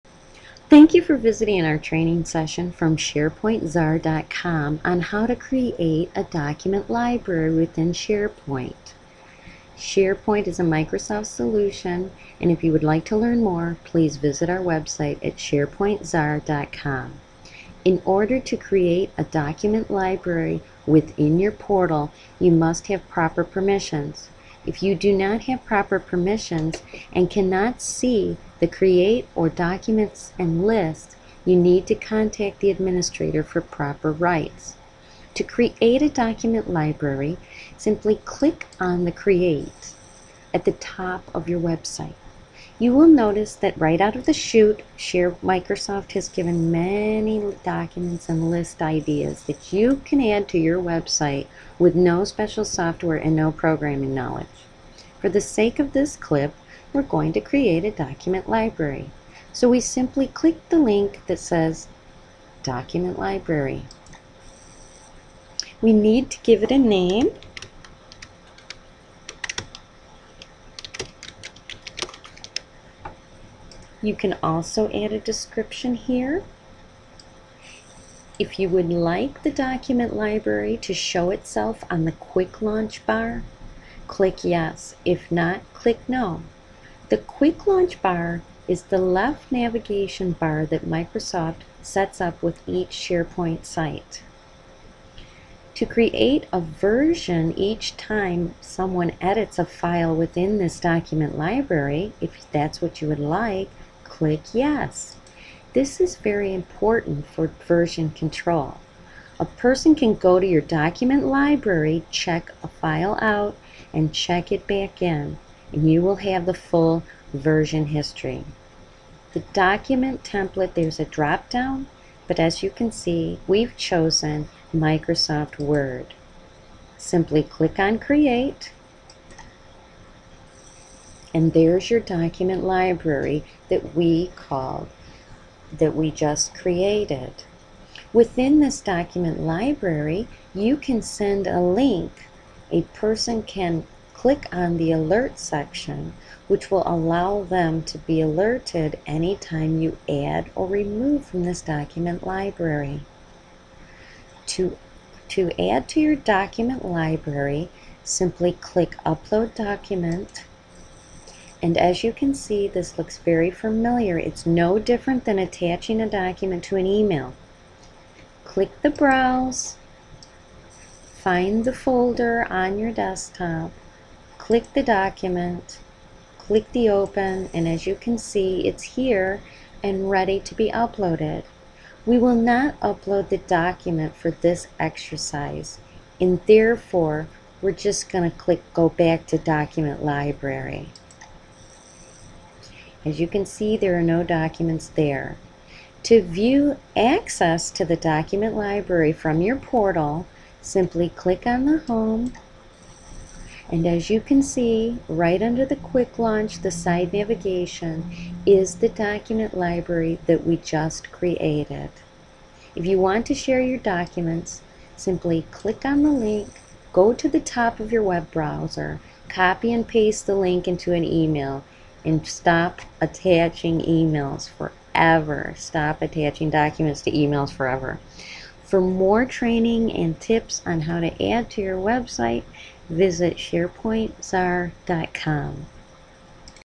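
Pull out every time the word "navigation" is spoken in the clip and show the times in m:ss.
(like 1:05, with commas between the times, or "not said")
1:29, 3:27.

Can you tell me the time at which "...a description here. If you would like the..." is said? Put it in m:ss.
1:15.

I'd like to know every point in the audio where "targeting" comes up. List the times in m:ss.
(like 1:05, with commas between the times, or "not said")
not said.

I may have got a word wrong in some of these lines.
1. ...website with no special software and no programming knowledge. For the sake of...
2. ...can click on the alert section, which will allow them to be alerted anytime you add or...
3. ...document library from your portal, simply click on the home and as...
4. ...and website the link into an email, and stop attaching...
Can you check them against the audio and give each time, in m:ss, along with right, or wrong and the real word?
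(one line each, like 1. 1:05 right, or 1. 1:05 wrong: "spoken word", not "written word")
1. 0:50 right
2. 2:23 right
3. 3:17 right
4. 3:39 wrong: "paste", not "website".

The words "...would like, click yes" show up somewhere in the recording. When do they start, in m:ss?
1:43.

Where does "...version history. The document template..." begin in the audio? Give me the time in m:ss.
1:57.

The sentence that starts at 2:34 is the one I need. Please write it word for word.
To, to add to your document library, simply click Upload Document and as you can see, this looks very familiar.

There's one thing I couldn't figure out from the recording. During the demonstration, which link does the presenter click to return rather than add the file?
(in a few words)
Go Back to Document Library.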